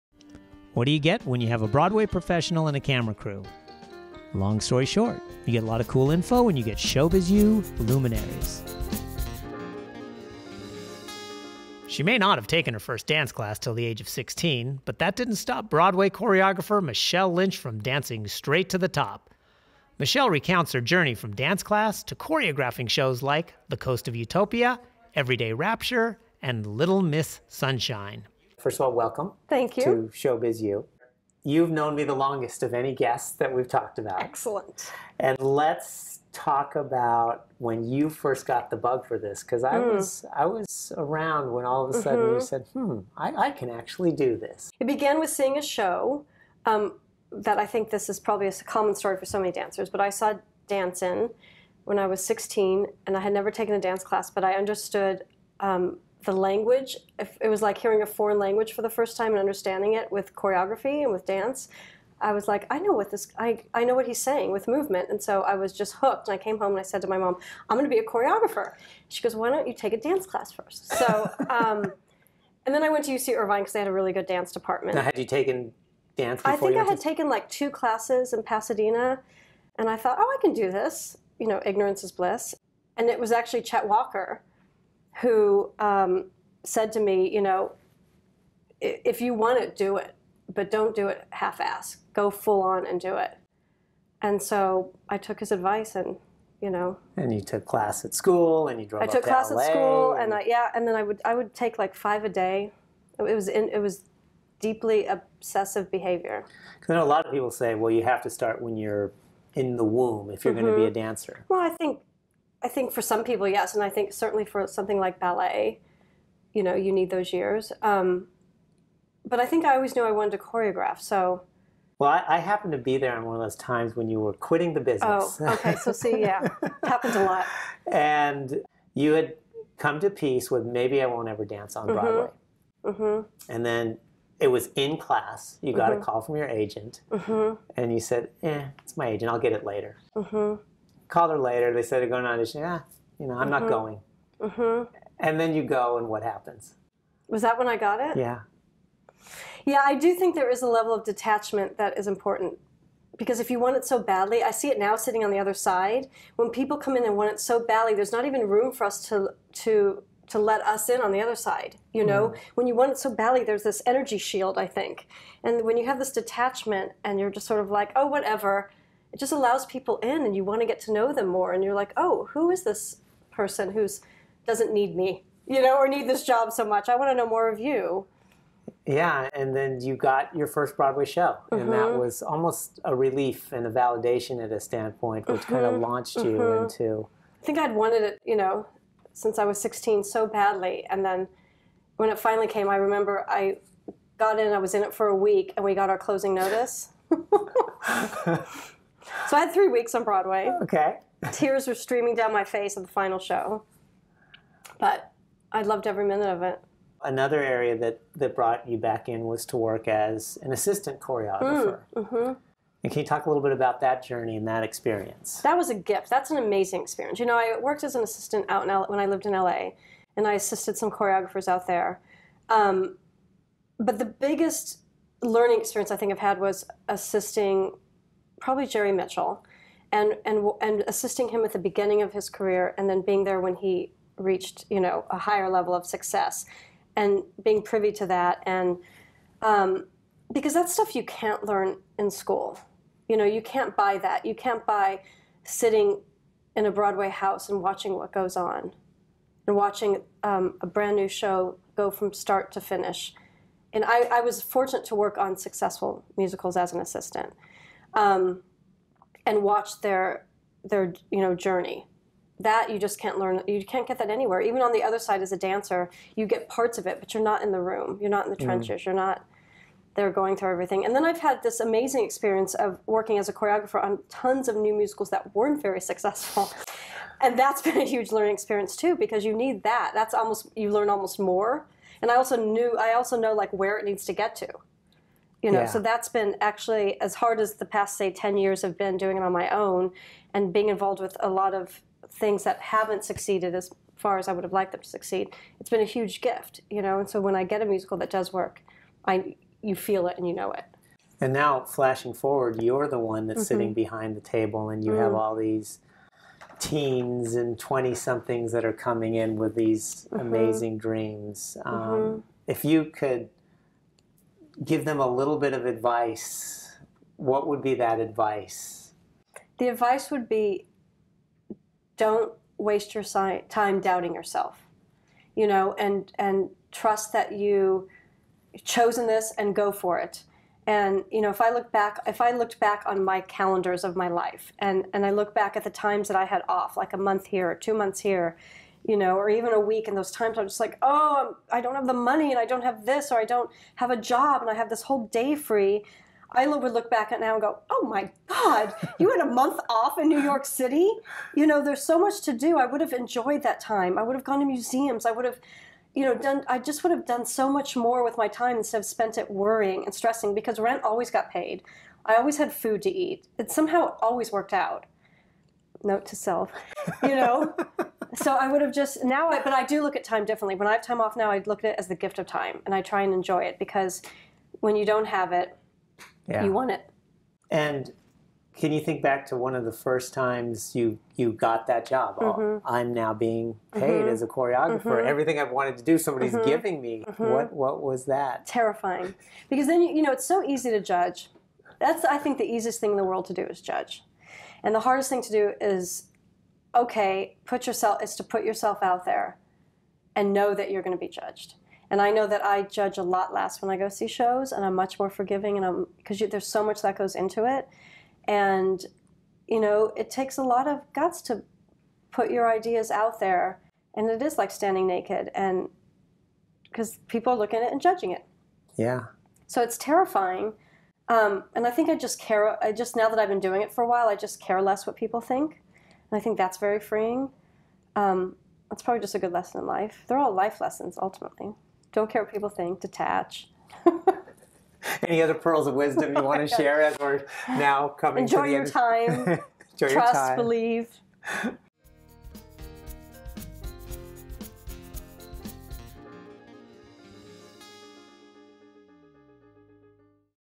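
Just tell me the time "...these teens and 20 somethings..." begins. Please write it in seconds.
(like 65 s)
305 s.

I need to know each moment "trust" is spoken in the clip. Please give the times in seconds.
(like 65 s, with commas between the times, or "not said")
326 s, 439 s.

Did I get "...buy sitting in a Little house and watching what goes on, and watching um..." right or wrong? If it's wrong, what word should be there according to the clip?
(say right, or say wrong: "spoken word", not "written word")
wrong: "Broadway", not "Little".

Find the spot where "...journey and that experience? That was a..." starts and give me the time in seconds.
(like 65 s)
214 s.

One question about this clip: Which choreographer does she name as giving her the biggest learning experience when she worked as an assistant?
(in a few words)
Jerry Mitchell.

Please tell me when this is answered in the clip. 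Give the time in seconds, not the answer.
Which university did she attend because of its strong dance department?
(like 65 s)
73 s.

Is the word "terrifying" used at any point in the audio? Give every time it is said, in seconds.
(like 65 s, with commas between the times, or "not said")
388 s, 419 s.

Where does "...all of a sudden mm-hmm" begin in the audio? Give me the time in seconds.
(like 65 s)
41 s.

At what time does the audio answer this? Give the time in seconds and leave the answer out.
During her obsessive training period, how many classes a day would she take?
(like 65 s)
101 s.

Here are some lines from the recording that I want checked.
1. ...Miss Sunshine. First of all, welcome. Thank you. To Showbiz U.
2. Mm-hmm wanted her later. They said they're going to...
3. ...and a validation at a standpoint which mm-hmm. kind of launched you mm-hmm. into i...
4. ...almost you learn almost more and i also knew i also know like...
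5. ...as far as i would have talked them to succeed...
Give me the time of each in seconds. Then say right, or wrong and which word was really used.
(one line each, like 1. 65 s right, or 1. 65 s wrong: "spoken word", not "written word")
1. 27 s right
2. 140 s wrong: "called", not "wanted"
3. 183 s right
4. 280 s right
5. 293 s wrong: "liked", not "talked".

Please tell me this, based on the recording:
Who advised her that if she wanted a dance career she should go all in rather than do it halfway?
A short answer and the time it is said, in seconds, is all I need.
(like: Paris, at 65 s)
Chet Walker, at 83 s.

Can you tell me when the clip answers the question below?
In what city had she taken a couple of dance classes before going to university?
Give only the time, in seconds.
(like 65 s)
78 s.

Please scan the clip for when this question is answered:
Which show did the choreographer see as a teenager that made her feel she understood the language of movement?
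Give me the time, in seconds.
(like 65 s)
50 s.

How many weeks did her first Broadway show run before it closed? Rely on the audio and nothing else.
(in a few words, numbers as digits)
3.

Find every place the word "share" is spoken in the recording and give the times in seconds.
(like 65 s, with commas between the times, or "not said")
436 s.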